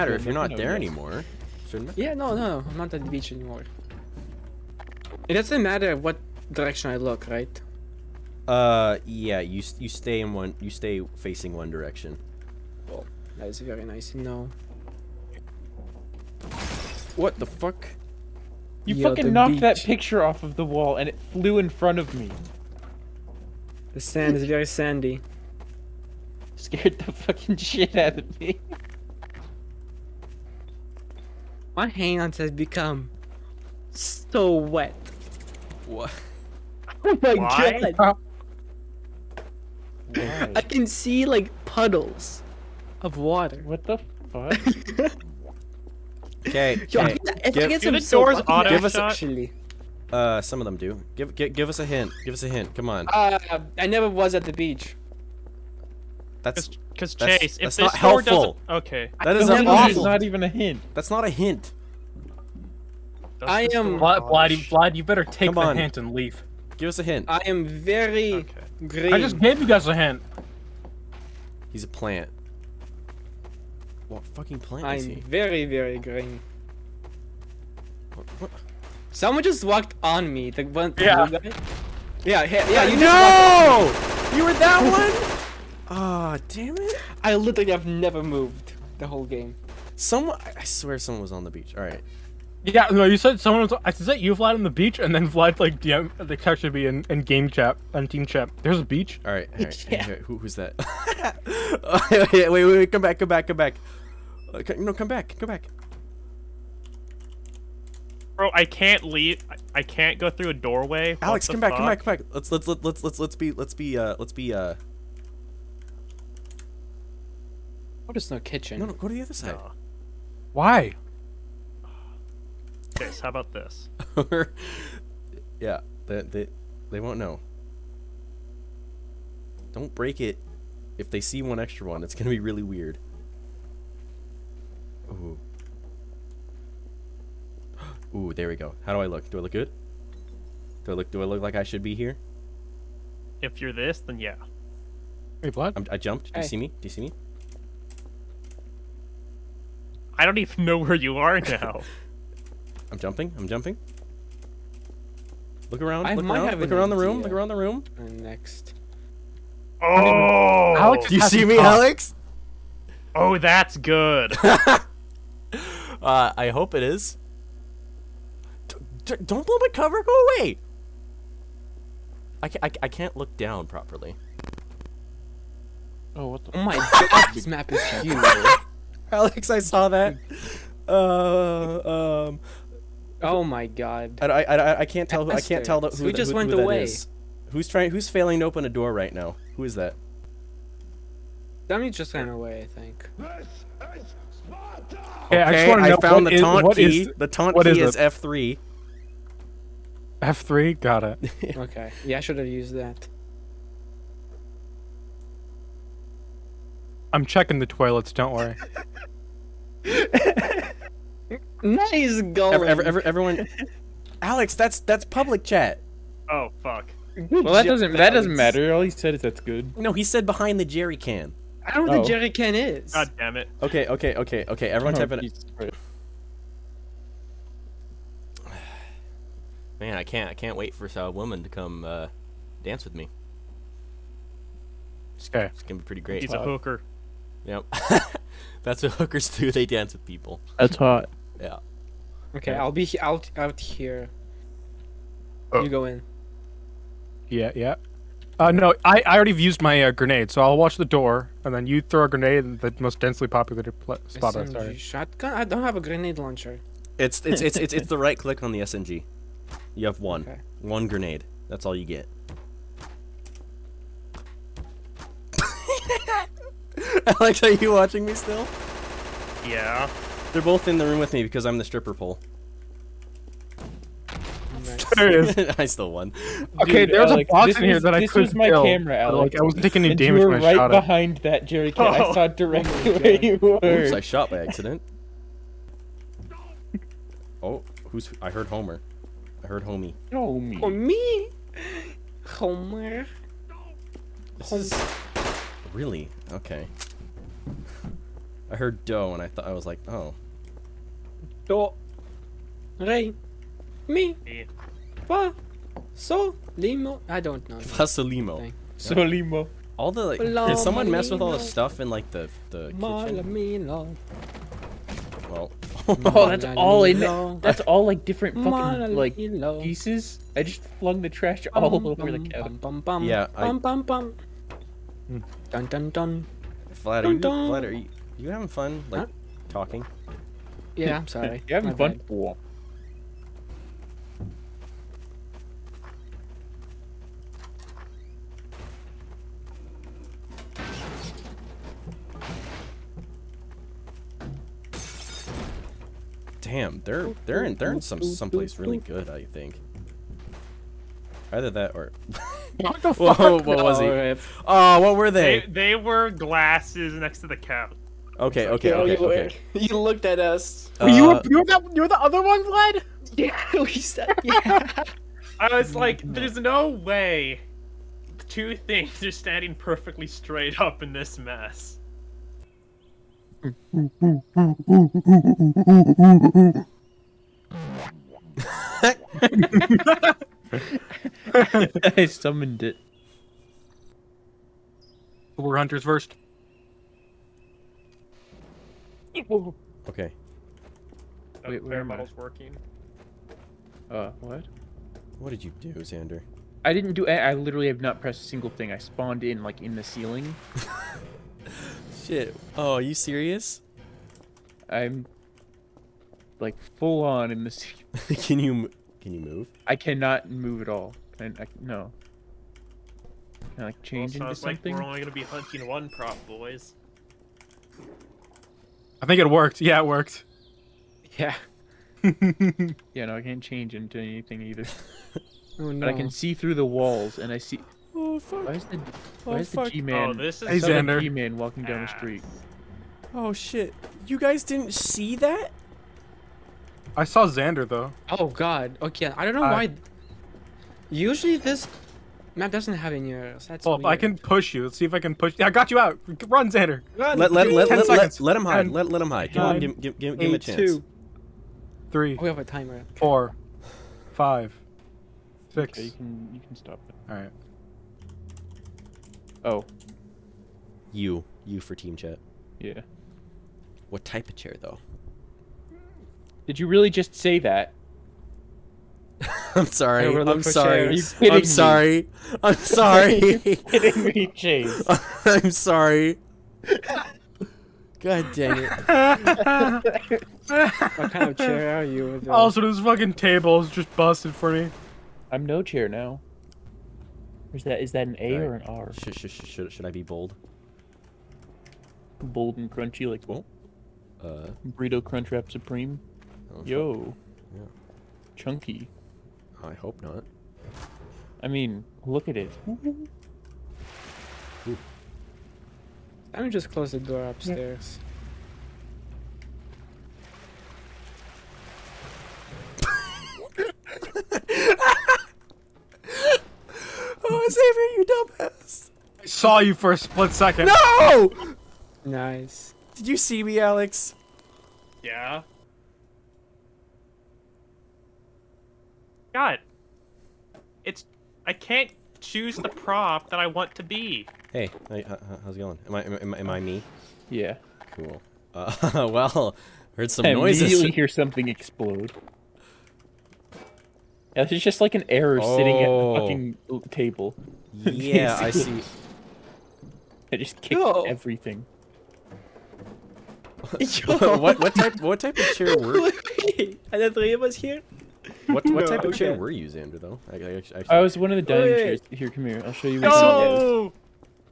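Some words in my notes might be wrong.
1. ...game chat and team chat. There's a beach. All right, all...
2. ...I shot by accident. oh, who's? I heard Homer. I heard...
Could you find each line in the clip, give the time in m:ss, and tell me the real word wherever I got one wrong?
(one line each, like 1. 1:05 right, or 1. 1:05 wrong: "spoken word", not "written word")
1. 1:37 right
2. 4:43 right.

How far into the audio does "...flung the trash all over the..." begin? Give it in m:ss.
5:20.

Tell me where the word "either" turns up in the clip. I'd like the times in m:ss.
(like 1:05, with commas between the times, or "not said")
5:51, 7:04.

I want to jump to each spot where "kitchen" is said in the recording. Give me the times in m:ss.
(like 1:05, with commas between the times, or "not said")
1:58, 5:12.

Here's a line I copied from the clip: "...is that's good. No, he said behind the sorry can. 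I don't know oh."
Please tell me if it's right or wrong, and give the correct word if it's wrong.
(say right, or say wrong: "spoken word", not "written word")
wrong: "jerry", not "sorry".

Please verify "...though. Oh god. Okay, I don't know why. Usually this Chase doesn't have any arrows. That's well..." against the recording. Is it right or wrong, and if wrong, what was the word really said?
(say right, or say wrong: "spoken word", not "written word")
wrong: "Matt", not "Chase".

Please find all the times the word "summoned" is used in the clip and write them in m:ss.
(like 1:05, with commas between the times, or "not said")
6:22.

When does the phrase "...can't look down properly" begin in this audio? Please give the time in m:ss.
2:52.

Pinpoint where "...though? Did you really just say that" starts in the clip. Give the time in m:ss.
7:44.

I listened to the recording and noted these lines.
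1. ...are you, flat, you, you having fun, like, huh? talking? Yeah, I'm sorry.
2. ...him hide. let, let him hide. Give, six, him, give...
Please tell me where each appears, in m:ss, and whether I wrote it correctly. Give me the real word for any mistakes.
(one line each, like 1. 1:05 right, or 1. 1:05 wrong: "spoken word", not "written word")
1. 5:27 right
2. 7:28 wrong: "nine", not "six".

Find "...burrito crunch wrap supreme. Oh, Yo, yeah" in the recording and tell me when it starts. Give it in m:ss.
8:14.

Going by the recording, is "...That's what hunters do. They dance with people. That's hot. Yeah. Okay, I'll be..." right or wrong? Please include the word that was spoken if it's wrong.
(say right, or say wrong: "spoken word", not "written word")
wrong: "hookers", not "hunters".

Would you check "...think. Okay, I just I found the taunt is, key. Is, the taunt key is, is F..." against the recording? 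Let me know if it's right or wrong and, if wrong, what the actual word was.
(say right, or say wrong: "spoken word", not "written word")
right.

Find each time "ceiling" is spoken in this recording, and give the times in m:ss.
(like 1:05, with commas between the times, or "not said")
6:39, 6:47.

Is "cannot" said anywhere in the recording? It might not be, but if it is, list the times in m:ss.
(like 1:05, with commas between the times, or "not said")
6:49.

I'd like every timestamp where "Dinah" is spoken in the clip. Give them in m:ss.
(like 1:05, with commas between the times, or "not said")
not said.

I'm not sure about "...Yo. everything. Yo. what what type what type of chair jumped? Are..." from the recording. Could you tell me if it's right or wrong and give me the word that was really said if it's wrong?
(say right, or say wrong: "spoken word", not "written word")
wrong: "worked", not "jumped".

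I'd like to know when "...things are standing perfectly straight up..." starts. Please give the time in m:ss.
6:08.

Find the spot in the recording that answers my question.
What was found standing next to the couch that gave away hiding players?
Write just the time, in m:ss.
5:56.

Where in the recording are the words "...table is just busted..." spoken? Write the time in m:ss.
8:03.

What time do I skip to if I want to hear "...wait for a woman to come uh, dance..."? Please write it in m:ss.
3:50.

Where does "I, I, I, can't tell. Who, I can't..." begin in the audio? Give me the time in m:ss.
3:04.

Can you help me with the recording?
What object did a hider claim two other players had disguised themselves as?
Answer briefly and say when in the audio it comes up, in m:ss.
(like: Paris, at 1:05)
Stripper pole, at 4:31.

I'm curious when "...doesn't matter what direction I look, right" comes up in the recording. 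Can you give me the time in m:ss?
0:05.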